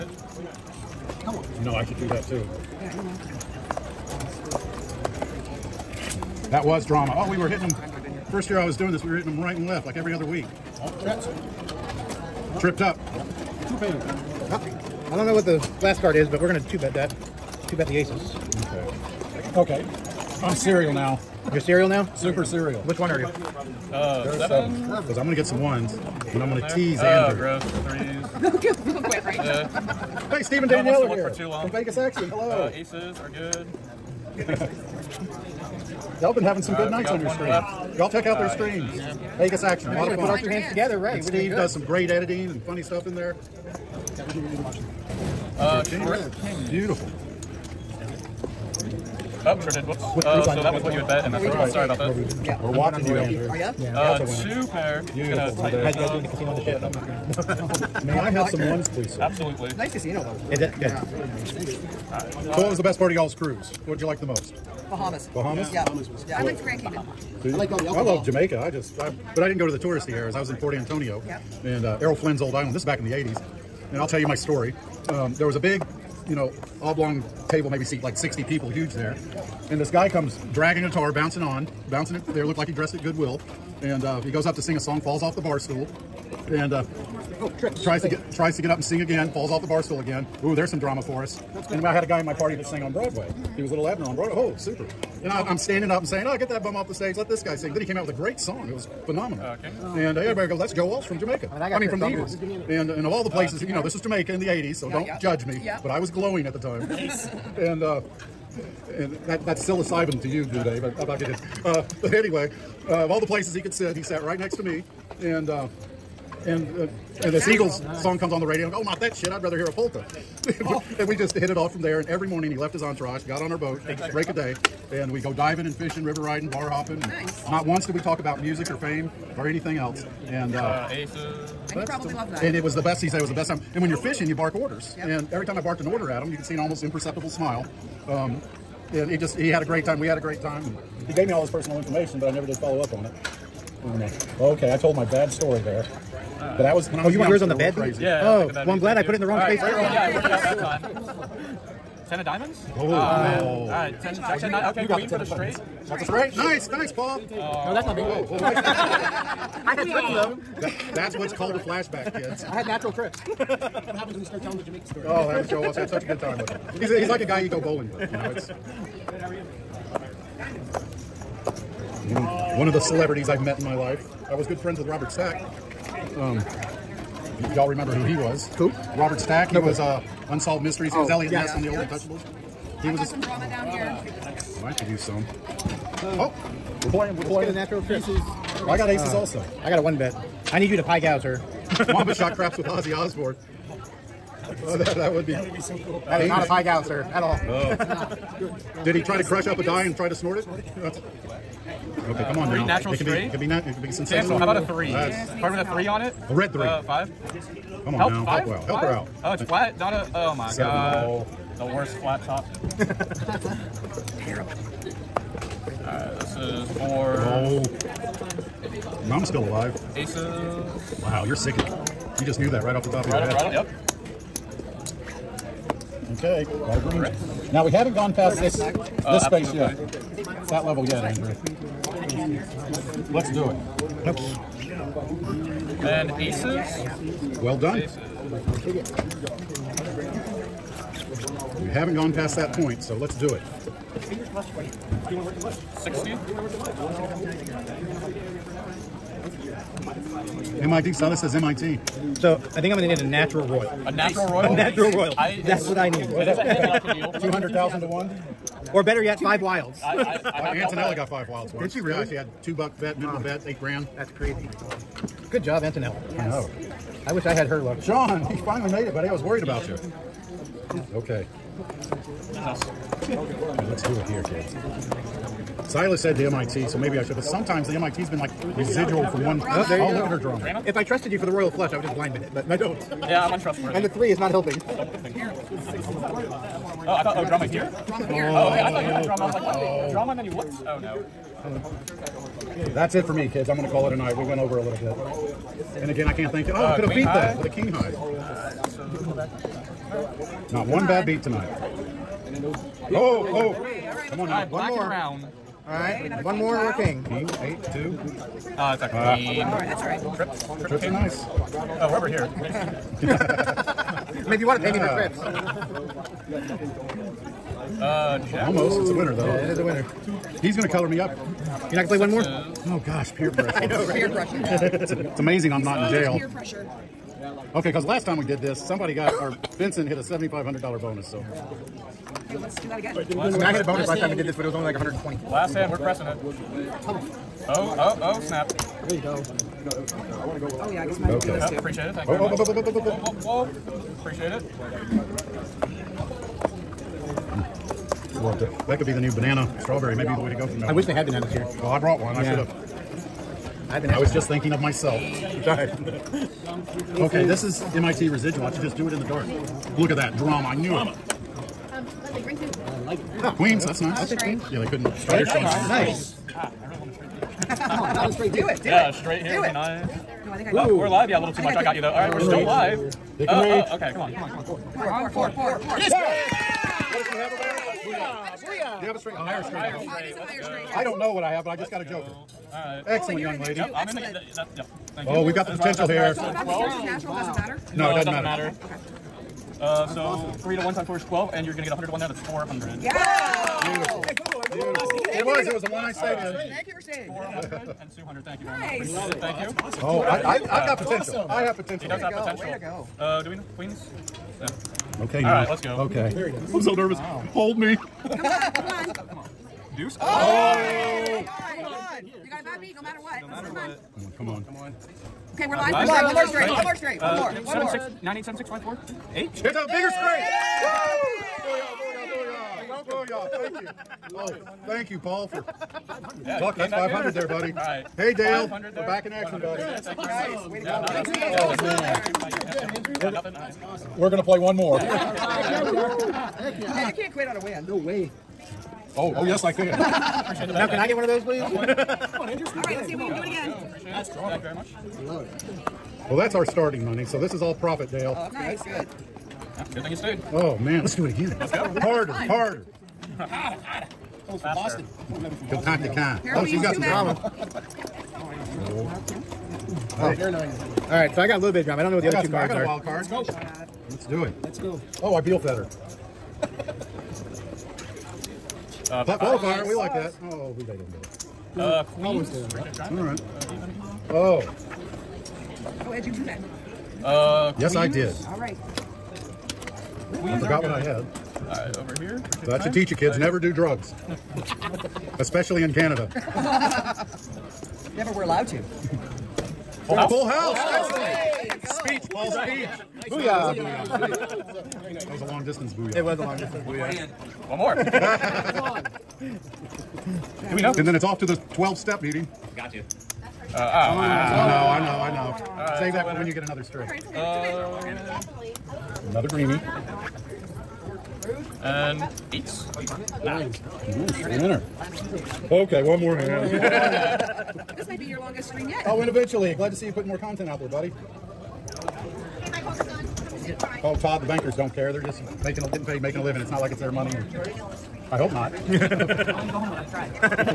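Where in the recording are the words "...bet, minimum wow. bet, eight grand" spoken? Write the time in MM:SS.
04:22.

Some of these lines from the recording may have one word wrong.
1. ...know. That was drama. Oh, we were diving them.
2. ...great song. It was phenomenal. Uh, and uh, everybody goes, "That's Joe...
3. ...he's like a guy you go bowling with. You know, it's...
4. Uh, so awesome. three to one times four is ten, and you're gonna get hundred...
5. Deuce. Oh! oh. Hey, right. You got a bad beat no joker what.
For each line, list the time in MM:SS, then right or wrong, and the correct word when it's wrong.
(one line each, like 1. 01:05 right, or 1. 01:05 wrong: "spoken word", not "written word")
1. 00:02 wrong: "hitting", not "diving"
2. 01:38 right
3. 02:46 right
4. 06:29 wrong: "twelve", not "ten"
5. 06:49 wrong: "matter", not "joker".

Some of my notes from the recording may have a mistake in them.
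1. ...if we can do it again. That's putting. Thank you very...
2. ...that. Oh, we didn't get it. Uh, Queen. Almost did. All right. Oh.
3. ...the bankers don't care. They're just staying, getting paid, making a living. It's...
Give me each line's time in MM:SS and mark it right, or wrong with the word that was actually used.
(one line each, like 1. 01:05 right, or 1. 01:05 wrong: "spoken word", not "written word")
1. 07:22 wrong: "strong", not "putting"
2. 07:49 right
3. 08:44 wrong: "making", not "staying".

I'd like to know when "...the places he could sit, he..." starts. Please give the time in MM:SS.
01:53.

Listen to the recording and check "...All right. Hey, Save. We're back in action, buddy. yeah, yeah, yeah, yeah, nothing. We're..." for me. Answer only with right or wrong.
wrong.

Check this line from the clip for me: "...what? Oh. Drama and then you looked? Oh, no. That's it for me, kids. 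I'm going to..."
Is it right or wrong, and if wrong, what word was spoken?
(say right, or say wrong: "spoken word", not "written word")
right.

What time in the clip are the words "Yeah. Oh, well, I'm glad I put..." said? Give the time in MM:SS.
02:28.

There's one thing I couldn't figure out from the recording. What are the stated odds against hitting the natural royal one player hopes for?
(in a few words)
200,000 to 1.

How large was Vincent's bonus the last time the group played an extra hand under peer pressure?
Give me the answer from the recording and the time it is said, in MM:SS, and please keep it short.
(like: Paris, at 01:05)
$7,500, at 05:29.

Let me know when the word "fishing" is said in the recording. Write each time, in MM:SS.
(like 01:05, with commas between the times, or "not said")
02:05, 02:13.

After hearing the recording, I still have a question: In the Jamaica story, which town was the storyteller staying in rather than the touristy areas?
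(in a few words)
Port Antonio.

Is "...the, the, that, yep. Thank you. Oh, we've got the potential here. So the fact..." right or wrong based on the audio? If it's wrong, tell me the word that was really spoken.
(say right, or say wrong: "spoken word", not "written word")
right.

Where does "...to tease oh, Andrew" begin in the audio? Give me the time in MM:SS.
00:26.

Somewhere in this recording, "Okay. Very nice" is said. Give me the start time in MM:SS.
06:45.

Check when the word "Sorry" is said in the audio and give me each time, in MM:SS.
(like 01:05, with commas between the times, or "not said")
00:51, 05:55.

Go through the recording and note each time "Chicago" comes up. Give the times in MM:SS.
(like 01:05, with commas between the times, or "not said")
not said.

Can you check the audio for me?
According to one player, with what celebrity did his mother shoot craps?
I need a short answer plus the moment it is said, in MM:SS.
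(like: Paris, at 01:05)
Ozzy Osbourne, at 03:12.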